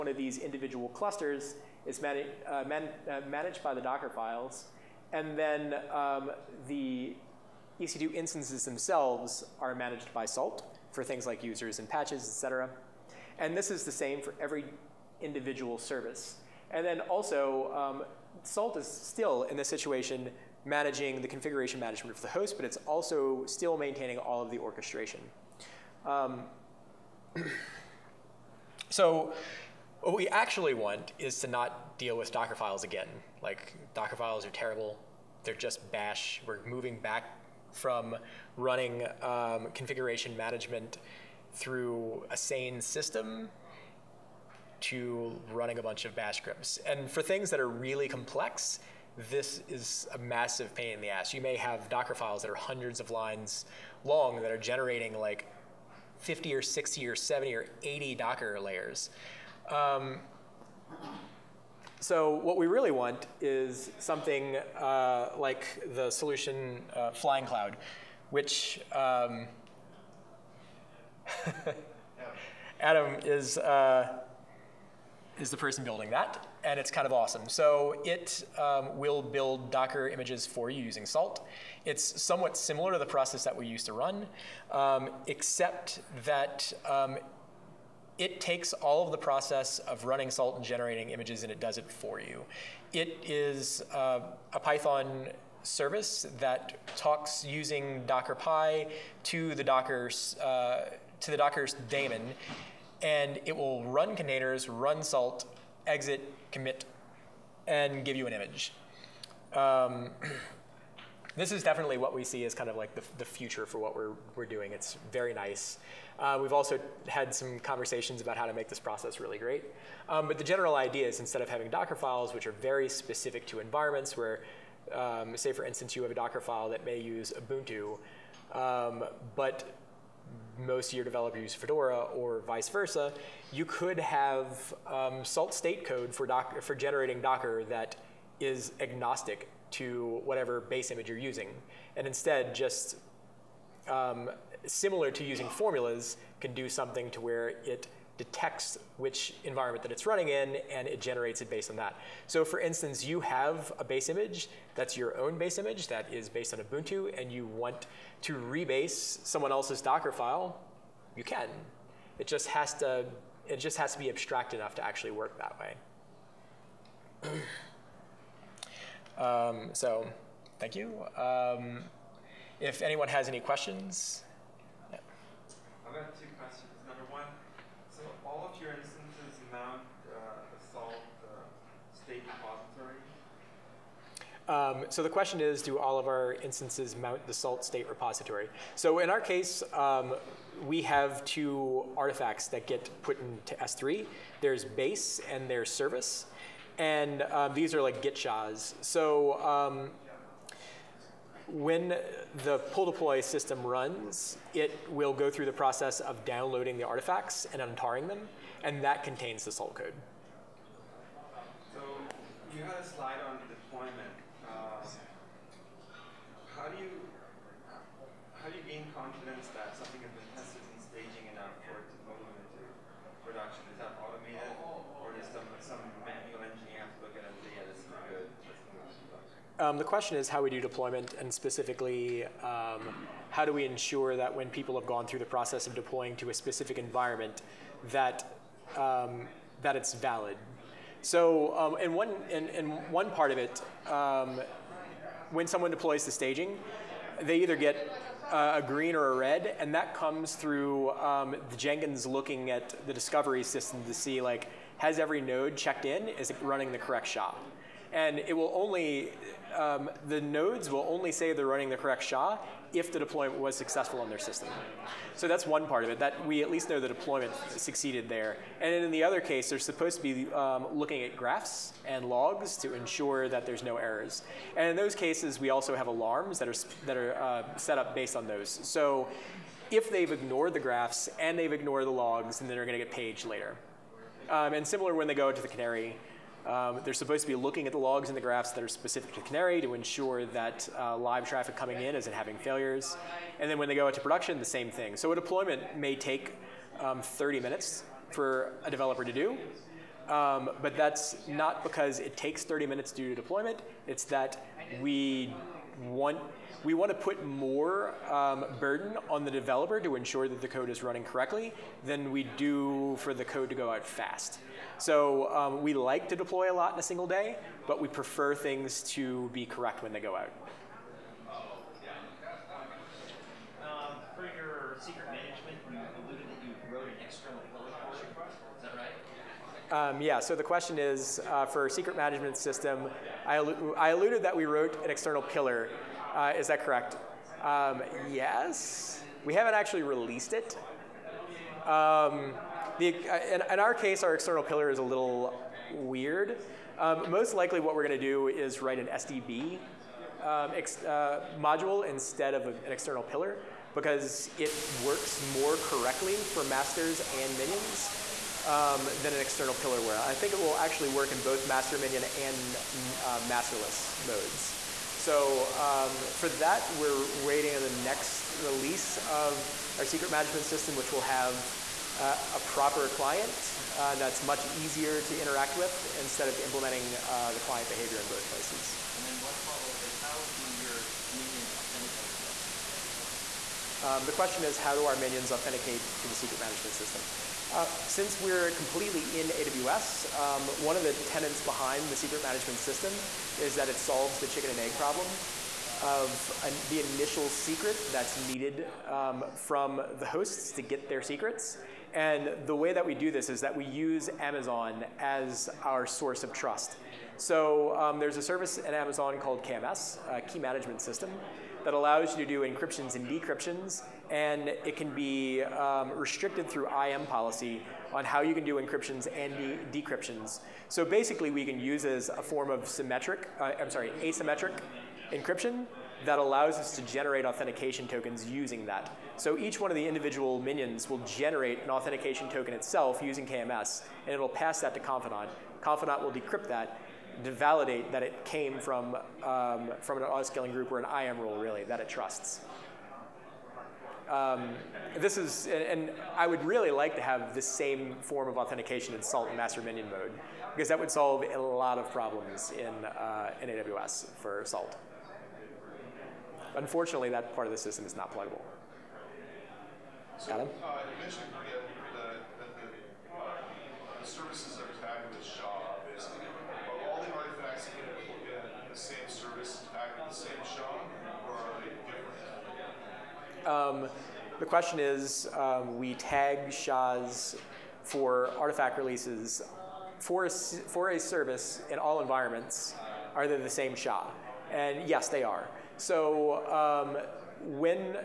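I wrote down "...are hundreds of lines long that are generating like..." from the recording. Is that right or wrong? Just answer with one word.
right.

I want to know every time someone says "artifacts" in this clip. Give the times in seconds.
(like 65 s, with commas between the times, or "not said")
191 s, 206 s, 478 s.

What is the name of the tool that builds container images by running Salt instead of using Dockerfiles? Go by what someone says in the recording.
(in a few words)
Flying Cloud.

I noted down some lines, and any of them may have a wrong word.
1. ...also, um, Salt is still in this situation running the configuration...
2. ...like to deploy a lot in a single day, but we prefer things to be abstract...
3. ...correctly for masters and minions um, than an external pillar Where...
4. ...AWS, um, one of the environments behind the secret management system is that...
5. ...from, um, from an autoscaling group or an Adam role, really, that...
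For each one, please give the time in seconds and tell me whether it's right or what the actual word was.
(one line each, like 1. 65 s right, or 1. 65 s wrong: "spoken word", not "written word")
1. 17 s wrong: "managing", not "running"
2. 315 s wrong: "correct", not "abstract"
3. 355 s right
4. 389 s wrong: "tenets", not "environments"
5. 438 s wrong: "IAM", not "Adam".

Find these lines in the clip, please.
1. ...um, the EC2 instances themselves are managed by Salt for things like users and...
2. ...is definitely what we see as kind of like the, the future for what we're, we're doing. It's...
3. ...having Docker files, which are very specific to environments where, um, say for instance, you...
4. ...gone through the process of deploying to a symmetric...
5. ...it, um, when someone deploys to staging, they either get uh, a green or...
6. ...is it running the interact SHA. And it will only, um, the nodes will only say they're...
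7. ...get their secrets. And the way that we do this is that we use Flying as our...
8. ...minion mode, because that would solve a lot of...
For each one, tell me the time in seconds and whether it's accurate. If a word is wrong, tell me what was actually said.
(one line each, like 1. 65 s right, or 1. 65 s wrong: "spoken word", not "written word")
1. 5 s right
2. 111 s right
3. 121 s right
4. 234 s wrong: "specific", not "symmetric"
5. 243 s right
6. 256 s wrong: "correct", not "interact"
7. 400 s wrong: "Amazon", not "Flying"
8. 449 s right.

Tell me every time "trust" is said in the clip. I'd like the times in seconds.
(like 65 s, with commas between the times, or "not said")
406 s, 441 s.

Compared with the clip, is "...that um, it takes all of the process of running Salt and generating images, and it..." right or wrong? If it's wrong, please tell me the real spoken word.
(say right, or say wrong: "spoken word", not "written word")
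right.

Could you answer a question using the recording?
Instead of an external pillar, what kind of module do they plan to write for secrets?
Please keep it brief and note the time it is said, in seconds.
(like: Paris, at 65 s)
SDB, at 348 s.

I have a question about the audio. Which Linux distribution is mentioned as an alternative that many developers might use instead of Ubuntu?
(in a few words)
Fedora.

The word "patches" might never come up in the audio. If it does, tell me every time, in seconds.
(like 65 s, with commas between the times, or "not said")
11 s.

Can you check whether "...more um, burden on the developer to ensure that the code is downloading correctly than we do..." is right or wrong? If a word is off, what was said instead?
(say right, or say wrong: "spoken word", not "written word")
wrong: "running", not "downloading".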